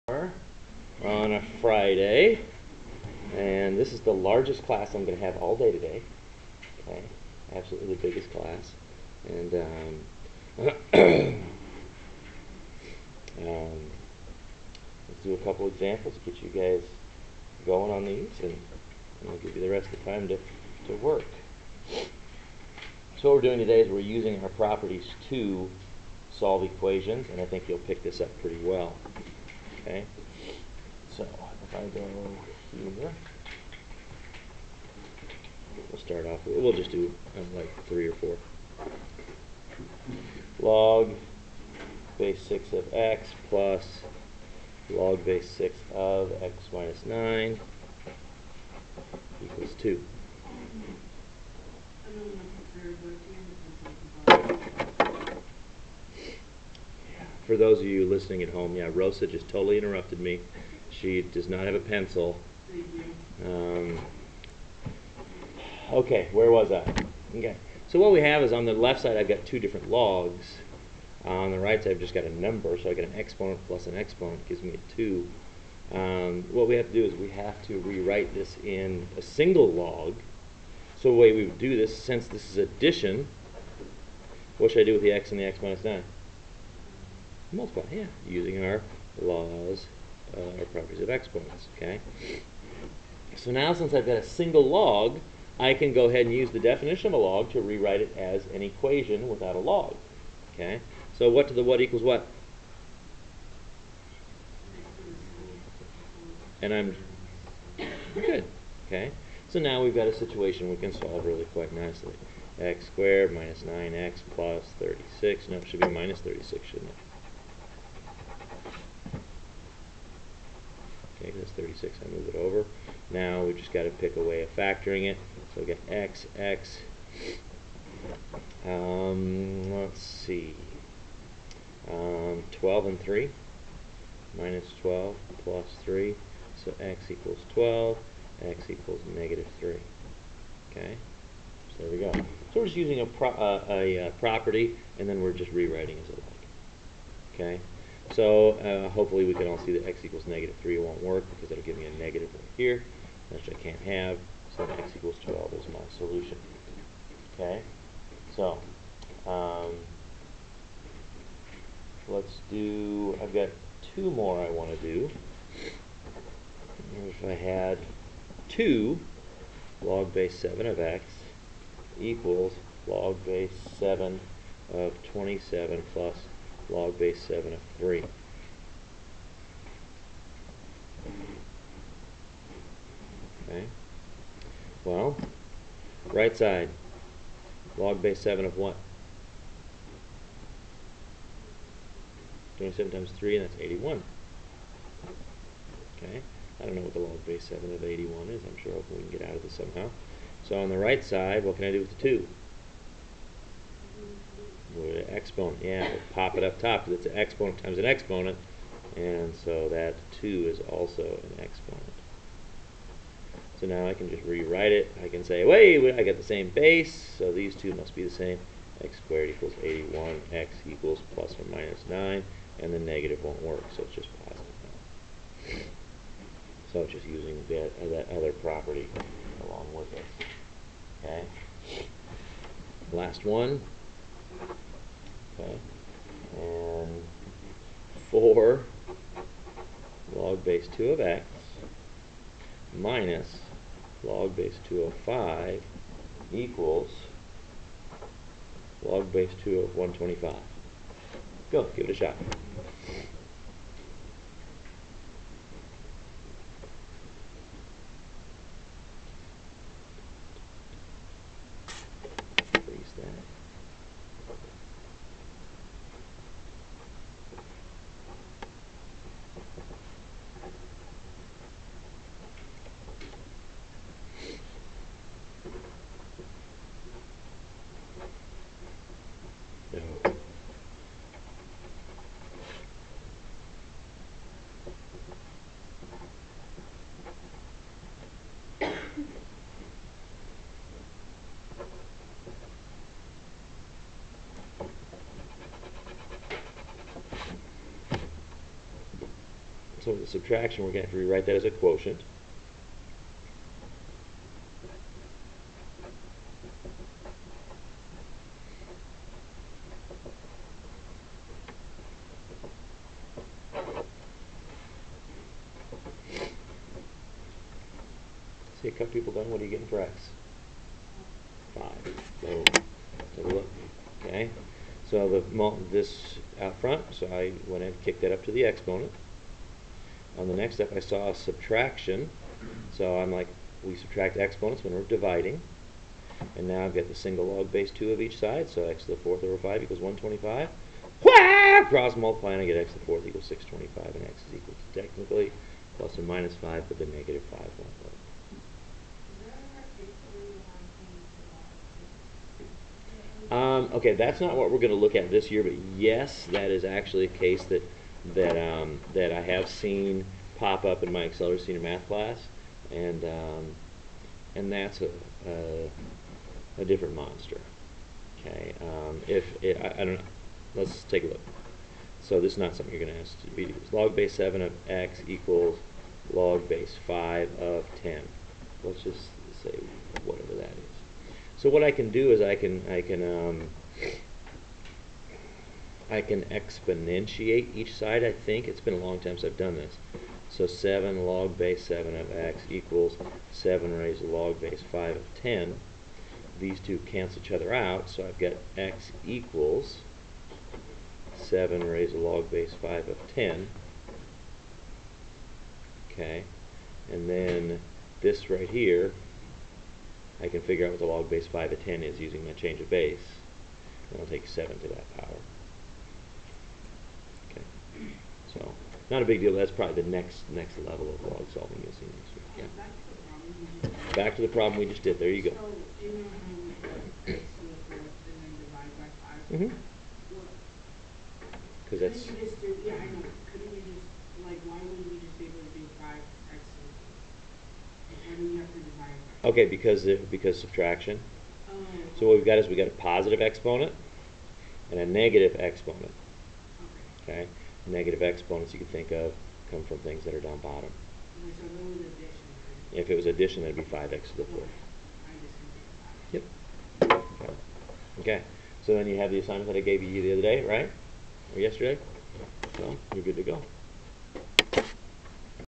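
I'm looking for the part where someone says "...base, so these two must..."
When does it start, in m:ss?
3:36.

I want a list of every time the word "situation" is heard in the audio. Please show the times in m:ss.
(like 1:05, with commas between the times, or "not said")
1:50.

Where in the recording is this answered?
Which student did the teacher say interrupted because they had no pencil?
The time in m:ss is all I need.
0:58.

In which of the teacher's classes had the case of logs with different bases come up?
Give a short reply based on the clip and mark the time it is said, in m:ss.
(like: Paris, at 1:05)
accelerated senior math class, at 6:01.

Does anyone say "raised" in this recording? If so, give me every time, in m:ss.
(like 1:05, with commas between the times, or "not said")
6:33, 6:41.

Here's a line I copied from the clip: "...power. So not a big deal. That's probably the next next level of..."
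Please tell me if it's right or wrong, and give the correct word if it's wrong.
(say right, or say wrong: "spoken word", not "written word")
right.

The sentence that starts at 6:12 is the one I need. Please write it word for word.
So this is not something you're going to ask to be Log base seven of x equals log base five of ten.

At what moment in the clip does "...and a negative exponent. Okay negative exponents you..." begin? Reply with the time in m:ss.
7:24.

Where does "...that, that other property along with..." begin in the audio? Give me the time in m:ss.
3:47.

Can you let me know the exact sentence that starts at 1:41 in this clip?
So what to the what equals what?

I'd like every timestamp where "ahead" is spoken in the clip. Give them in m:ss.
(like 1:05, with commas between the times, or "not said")
1:36.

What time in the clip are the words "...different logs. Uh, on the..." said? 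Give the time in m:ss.
1:09.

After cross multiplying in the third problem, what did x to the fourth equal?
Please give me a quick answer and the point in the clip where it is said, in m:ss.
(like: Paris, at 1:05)
625, at 5:43.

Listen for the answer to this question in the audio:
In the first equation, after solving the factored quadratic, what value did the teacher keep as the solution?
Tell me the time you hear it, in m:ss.
2:34.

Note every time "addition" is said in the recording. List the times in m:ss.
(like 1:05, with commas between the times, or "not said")
1:22, 7:33.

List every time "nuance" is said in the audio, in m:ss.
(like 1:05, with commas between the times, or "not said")
not said.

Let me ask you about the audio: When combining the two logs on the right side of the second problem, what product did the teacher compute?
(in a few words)
81.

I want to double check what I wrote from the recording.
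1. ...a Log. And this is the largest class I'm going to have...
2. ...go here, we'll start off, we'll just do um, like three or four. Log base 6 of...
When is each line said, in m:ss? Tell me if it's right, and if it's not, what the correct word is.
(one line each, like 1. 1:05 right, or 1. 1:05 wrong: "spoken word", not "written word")
1. 0:01 wrong: "Friday", not "Log"
2. 0:31 right.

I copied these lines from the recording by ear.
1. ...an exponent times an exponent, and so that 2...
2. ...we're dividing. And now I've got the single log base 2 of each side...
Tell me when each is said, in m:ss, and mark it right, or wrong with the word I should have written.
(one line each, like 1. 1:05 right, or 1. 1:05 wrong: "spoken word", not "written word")
1. 3:27 right
2. 5:34 right.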